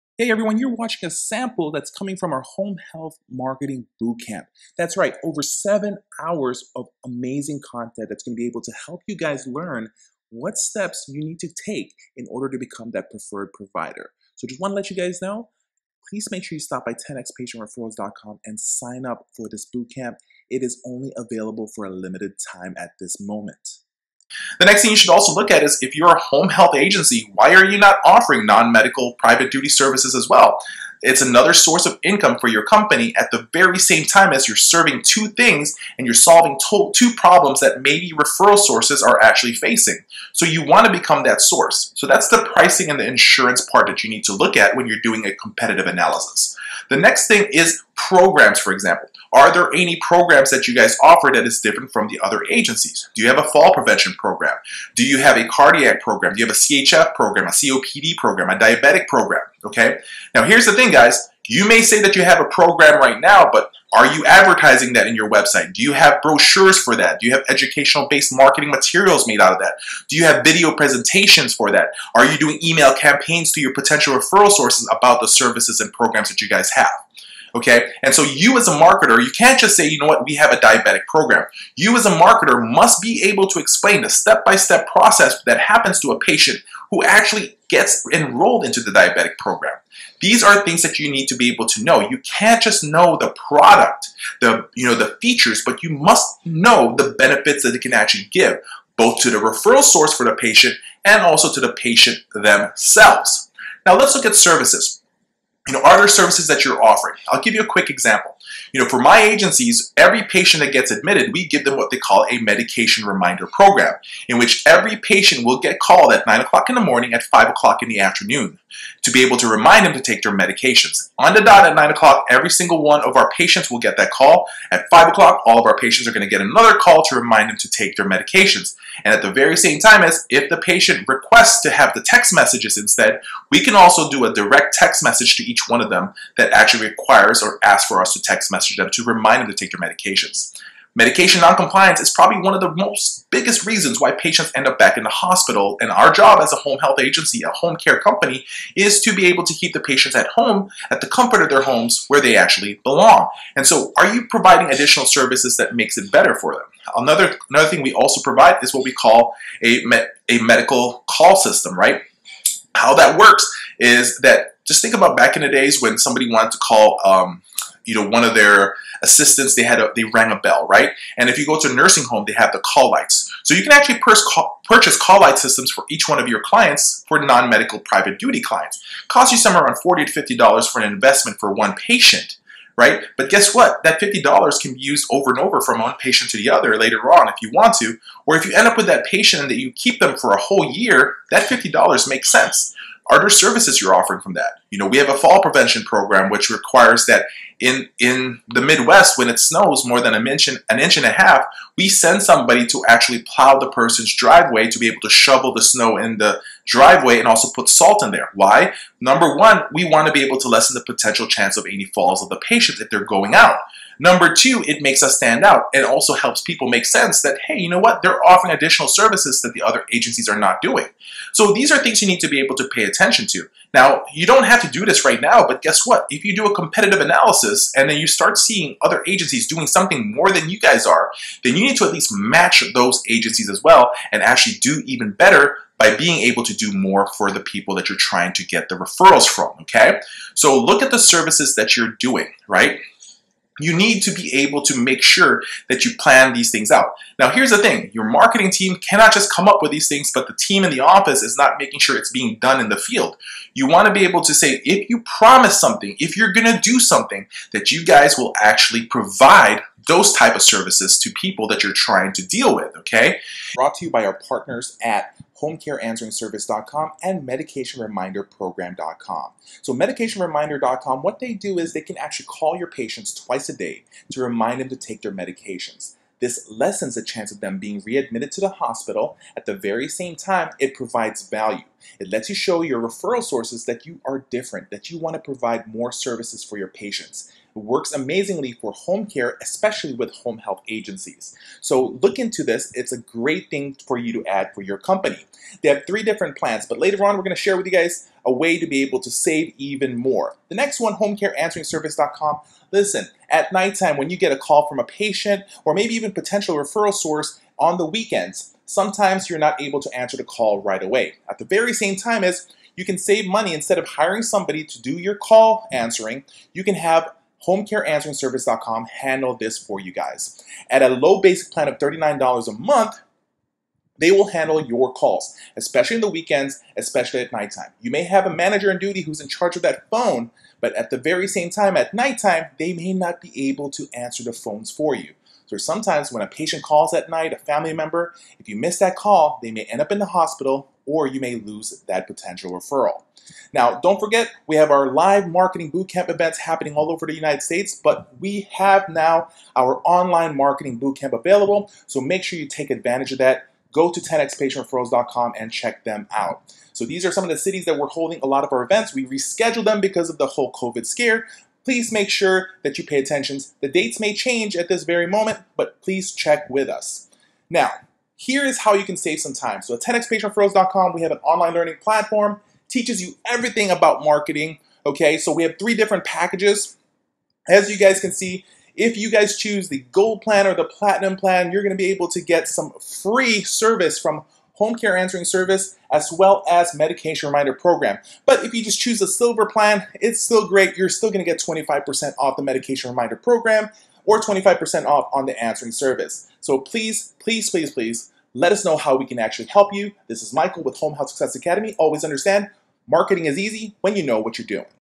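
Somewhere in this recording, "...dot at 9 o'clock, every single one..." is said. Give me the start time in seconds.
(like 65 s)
121 s.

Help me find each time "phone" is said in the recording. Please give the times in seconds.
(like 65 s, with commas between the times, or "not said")
329 s, 334 s.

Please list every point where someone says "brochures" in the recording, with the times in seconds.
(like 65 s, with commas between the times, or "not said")
66 s.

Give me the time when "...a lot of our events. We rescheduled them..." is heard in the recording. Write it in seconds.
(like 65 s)
358 s.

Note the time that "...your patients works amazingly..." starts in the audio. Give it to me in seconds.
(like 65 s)
286 s.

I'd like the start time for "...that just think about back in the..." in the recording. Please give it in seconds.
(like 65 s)
164 s.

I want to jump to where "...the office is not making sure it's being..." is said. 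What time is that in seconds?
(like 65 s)
250 s.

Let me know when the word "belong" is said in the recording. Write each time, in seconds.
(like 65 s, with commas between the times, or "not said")
152 s.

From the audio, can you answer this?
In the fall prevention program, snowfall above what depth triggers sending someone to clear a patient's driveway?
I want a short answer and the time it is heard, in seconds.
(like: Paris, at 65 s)
an inch and a half, at 200 s.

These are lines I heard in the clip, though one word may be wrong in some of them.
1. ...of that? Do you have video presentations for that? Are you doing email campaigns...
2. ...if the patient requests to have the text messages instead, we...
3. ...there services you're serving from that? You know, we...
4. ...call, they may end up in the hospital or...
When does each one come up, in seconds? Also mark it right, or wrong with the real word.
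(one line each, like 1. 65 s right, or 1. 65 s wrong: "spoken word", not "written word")
1. 69 s right
2. 130 s right
3. 193 s wrong: "offering", not "serving"
4. 338 s right.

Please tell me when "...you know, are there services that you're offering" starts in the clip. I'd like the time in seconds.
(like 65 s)
105 s.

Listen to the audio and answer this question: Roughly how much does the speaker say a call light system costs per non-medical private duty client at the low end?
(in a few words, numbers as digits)
$40.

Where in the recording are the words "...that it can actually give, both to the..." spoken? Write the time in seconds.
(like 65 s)
97 s.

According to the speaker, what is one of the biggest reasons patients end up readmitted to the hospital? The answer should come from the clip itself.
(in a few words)
Medication noncompliance.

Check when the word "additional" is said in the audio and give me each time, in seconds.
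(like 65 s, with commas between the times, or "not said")
154 s, 218 s.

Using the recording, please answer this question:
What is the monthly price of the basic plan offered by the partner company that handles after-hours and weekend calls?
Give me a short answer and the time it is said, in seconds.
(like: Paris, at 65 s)
$39, at 321 s.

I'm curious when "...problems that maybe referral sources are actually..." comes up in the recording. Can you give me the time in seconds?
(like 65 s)
37 s.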